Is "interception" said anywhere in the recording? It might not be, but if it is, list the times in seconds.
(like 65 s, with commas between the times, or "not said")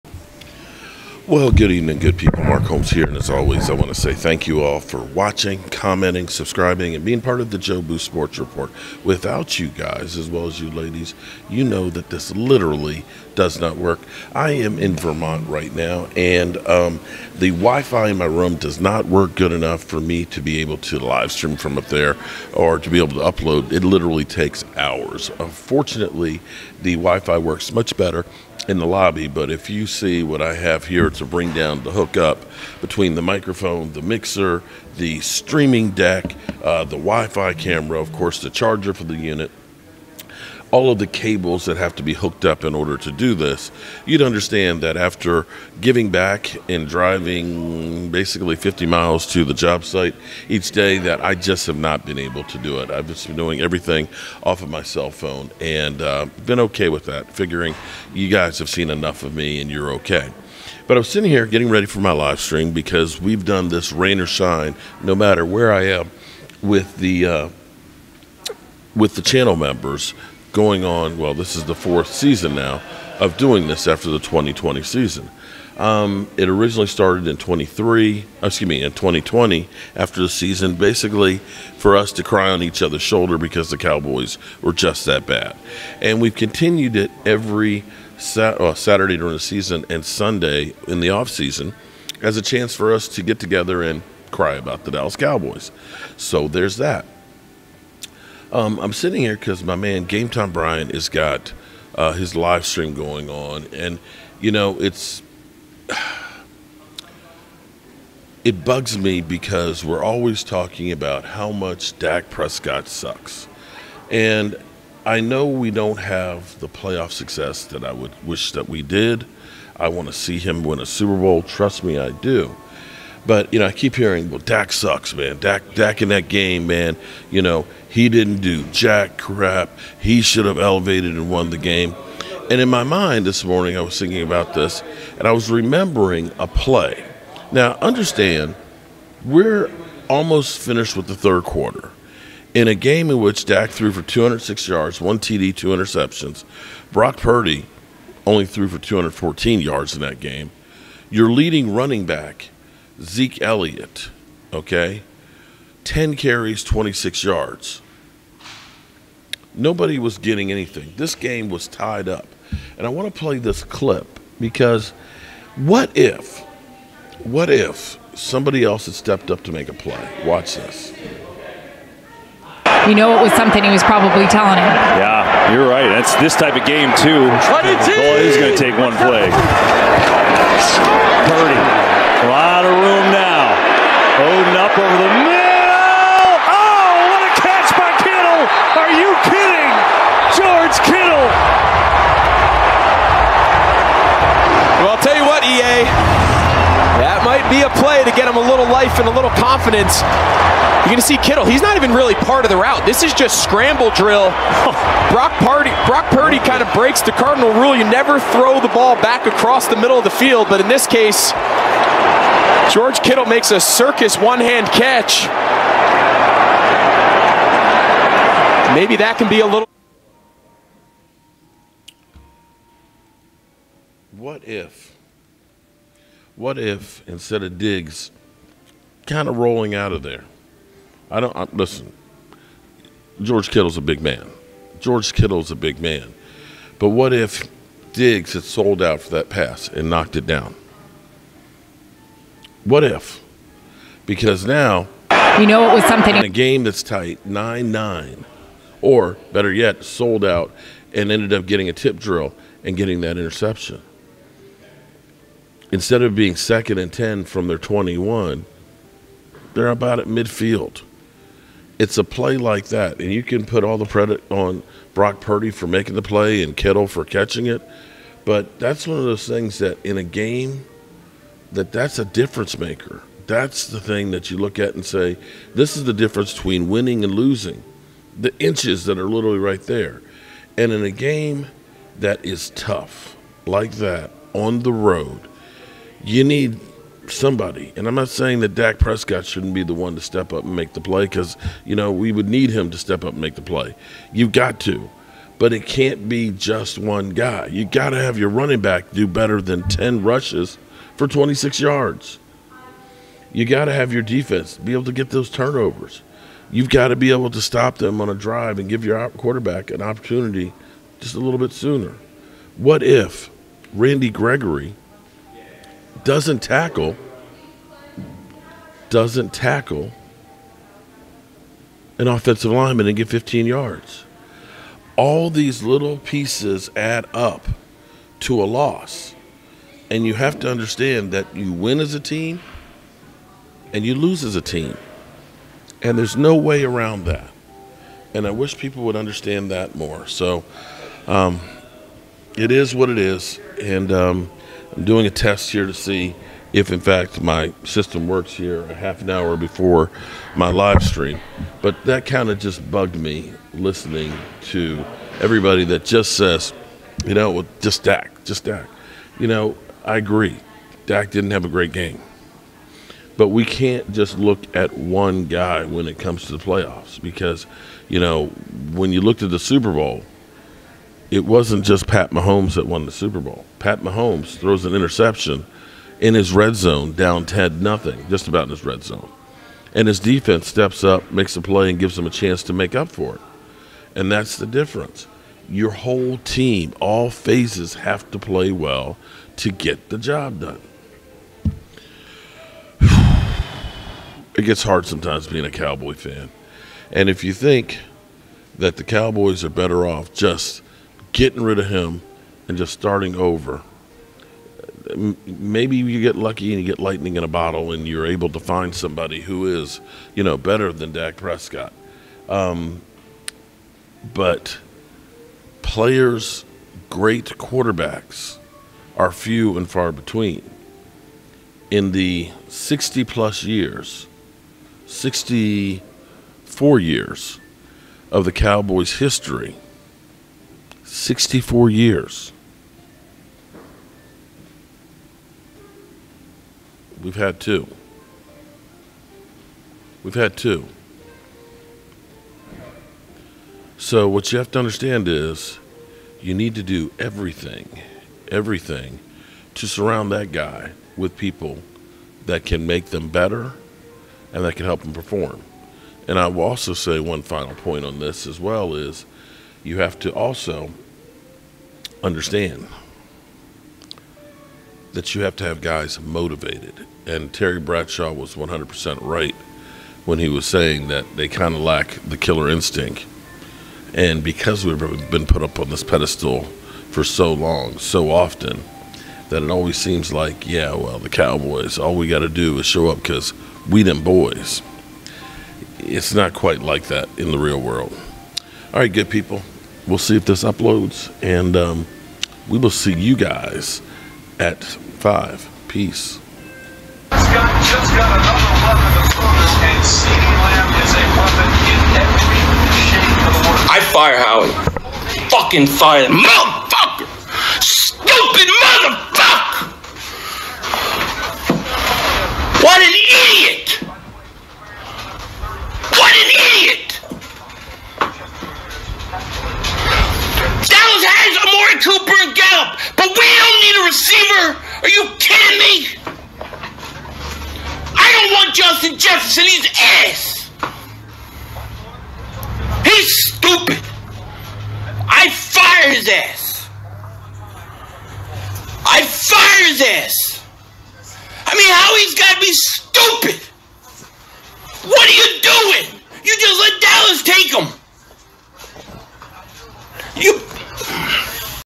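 145 s, 253 s, 374 s.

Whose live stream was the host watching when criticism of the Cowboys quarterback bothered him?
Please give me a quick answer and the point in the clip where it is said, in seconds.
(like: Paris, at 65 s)
Game Time Brian, at 100 s.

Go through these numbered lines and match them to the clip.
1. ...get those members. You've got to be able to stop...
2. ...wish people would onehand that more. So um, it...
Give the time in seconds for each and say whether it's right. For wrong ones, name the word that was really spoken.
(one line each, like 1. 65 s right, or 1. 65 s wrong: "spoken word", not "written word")
1. 304 s wrong: "turnovers", not "members"
2. 338 s wrong: "understand", not "onehand".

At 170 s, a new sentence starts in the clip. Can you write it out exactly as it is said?
Watch this you know it was something he was probably telling him.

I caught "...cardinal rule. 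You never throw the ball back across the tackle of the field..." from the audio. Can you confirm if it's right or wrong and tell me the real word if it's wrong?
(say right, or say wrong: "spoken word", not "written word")
wrong: "middle", not "tackle".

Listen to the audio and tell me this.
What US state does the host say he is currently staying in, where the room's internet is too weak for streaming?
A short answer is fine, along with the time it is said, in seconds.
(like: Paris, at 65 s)
Vermont, at 14 s.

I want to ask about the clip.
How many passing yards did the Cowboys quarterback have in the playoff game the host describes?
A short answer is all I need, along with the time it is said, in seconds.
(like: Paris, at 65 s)
206, at 144 s.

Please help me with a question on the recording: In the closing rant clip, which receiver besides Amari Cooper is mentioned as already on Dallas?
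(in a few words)
Gallup.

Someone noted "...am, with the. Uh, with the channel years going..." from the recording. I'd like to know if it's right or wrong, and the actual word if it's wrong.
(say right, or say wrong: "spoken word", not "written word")
wrong: "members", not "years".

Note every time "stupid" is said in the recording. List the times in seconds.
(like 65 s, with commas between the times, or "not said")
507 s, 533 s, 542 s.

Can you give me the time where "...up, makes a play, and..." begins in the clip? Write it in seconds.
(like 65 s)
380 s.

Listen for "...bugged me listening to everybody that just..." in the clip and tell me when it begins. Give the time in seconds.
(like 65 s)
352 s.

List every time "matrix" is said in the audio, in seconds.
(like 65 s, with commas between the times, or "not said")
not said.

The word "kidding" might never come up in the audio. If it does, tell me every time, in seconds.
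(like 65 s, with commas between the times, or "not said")
189 s, 525 s.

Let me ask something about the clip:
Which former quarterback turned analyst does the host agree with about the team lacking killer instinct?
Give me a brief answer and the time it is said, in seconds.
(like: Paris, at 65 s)
Terry Bradshaw, at 467 s.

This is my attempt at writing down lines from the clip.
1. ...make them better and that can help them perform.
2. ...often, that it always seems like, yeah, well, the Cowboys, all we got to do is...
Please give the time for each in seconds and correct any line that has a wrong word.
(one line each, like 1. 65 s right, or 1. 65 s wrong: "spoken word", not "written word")
1. 452 s right
2. 478 s right.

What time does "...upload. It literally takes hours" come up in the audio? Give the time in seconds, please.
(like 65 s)
23 s.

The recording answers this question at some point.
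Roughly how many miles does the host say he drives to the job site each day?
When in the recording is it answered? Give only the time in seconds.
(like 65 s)
48 s.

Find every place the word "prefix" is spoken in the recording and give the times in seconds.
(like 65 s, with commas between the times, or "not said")
not said.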